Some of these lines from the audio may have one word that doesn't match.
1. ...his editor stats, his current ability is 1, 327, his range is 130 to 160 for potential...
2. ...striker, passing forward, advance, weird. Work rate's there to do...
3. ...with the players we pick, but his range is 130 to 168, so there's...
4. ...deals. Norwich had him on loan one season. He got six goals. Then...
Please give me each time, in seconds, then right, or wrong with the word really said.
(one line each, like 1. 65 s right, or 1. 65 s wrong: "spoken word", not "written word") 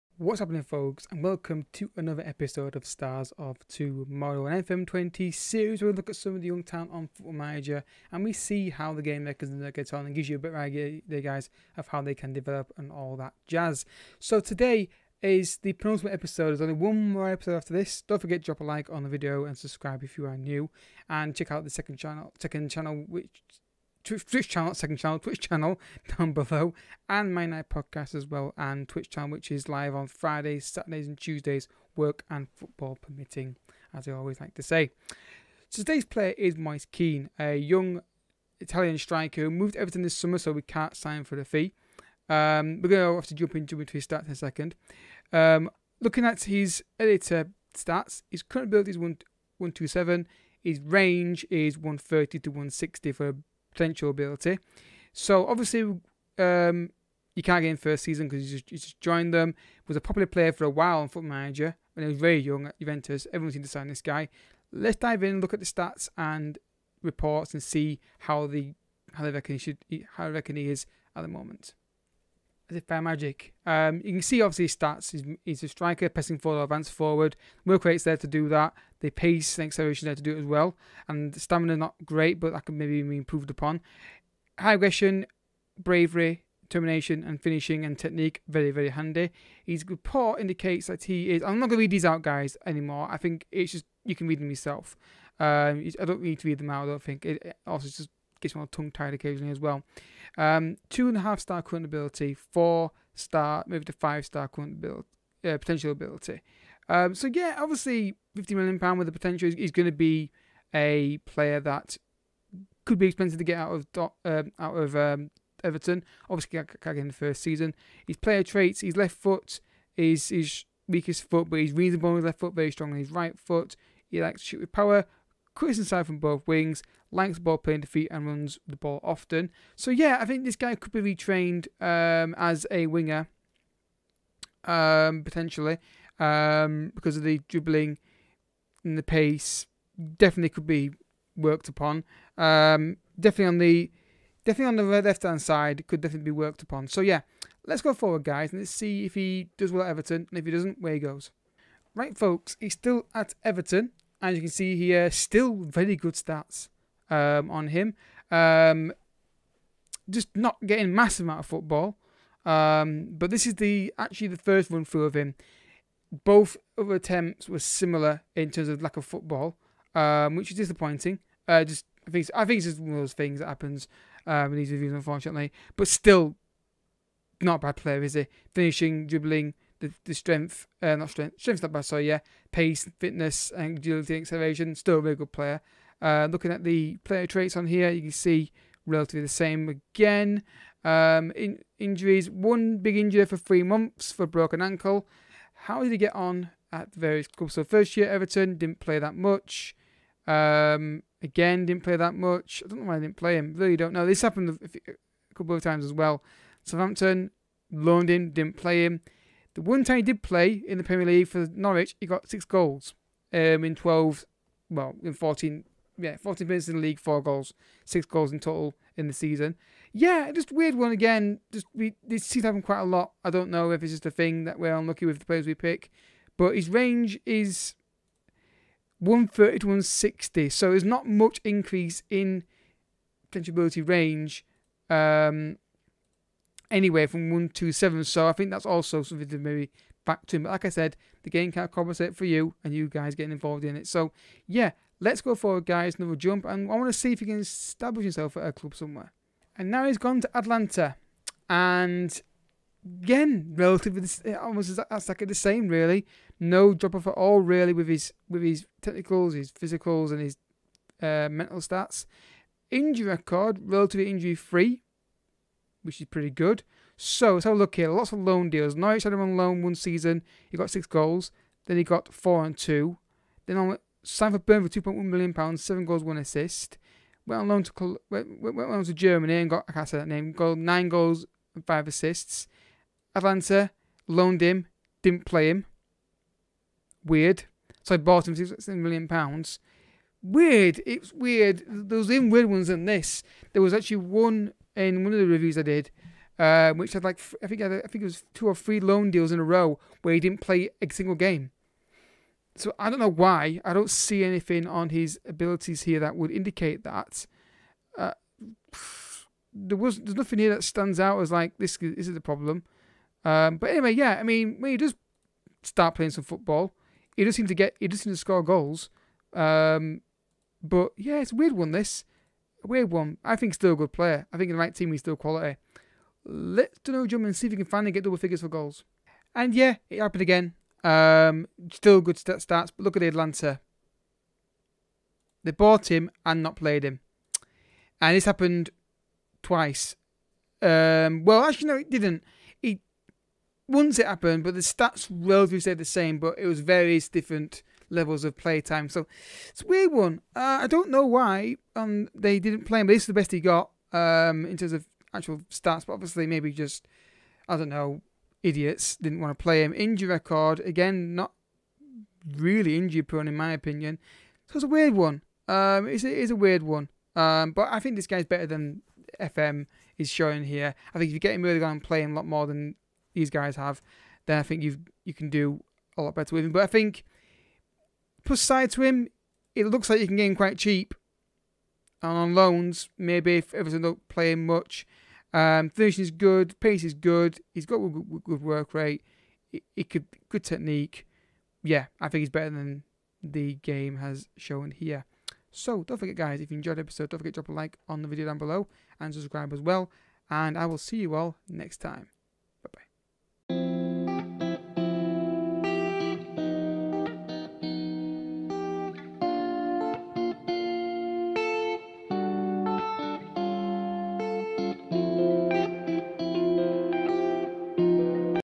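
1. 46 s wrong: "127", not "327"
2. 75 s wrong: "forward", not "weird"
3. 225 s wrong: "160", not "168"
4. 268 s right.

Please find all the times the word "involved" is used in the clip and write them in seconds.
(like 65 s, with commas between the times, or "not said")
243 s.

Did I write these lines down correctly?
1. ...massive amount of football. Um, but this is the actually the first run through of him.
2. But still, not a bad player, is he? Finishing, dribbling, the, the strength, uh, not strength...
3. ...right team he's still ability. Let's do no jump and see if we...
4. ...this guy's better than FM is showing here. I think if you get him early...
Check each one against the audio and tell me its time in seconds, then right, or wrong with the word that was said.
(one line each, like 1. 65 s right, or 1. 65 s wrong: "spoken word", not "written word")
1. 160 s right
2. 175 s right
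3. 324 s wrong: "quality", not "ability"
4. 367 s right.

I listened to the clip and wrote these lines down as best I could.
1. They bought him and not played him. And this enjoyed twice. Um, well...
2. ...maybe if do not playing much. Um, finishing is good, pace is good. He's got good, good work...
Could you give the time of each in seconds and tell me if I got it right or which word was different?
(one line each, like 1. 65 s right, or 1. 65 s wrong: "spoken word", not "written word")
1. 335 s wrong: "happened", not "enjoyed"
2. 382 s right.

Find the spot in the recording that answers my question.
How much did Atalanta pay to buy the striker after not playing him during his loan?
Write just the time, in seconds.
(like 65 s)
288 s.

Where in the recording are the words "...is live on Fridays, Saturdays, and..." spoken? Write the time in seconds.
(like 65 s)
29 s.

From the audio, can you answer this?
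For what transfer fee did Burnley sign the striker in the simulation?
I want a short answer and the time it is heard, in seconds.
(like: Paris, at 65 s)
2.1 million pounds, at 274 s.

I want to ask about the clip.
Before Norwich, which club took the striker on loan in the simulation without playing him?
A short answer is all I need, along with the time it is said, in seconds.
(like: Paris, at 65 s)
Southampton, at 206 s.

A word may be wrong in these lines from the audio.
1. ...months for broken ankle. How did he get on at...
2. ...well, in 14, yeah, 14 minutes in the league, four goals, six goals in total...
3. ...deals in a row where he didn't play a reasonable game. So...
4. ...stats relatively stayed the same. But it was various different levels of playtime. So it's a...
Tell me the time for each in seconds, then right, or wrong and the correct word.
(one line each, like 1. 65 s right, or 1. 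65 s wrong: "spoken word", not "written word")
1. 193 s right
2. 214 s right
3. 299 s wrong: "single", not "reasonable"
4. 344 s right.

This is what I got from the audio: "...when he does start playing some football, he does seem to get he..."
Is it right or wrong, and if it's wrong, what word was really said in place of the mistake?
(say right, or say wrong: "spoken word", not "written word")
right.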